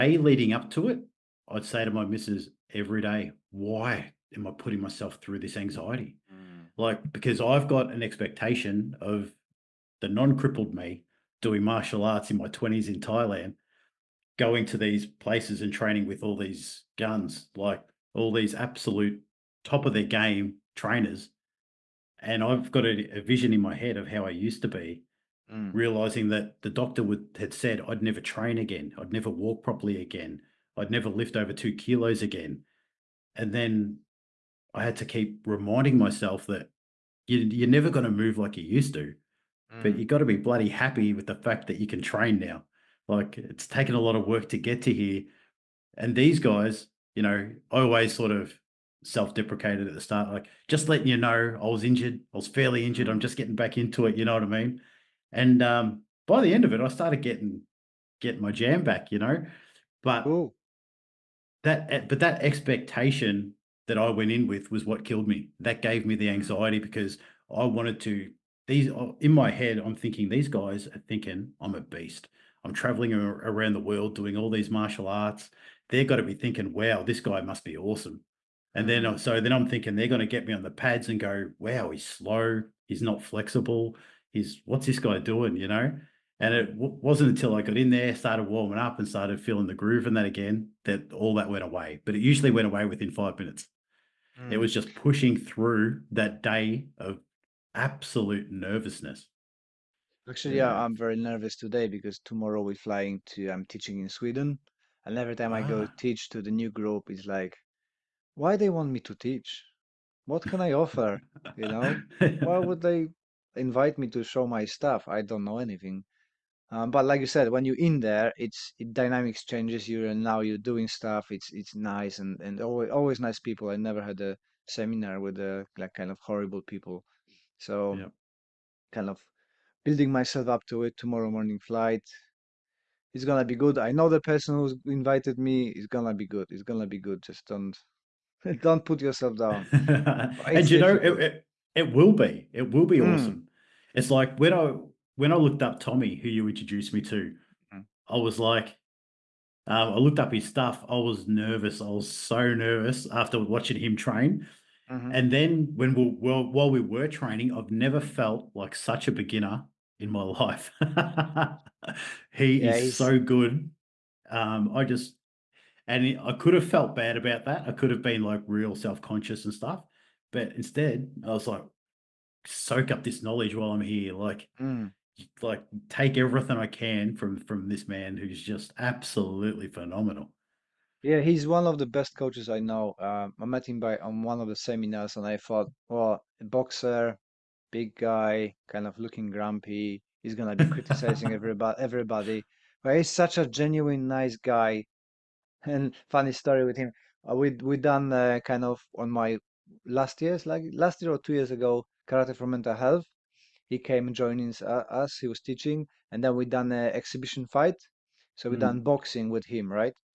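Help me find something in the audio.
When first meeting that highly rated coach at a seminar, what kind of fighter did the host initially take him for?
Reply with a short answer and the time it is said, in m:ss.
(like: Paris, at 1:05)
boxer, at 3:06.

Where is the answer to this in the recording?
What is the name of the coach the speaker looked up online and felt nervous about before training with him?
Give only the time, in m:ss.
2:25.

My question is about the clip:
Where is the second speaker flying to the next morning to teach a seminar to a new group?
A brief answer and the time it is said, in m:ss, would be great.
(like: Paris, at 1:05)
Sweden, at 1:44.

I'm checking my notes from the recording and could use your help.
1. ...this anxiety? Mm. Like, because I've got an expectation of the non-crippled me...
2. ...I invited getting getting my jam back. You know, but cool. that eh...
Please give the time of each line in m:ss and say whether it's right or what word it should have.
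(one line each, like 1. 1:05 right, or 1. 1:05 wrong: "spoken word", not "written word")
1. 0:05 right
2. 0:56 wrong: "started", not "invited".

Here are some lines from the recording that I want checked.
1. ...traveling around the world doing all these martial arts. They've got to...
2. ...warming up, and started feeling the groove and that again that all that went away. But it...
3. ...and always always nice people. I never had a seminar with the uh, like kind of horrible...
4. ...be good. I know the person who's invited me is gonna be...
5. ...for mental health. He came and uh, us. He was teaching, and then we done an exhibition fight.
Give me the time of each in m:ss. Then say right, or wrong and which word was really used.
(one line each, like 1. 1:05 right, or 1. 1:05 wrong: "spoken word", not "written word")
1. 1:12 right
2. 1:28 right
3. 2:02 right
4. 2:13 right
5. 3:22 right.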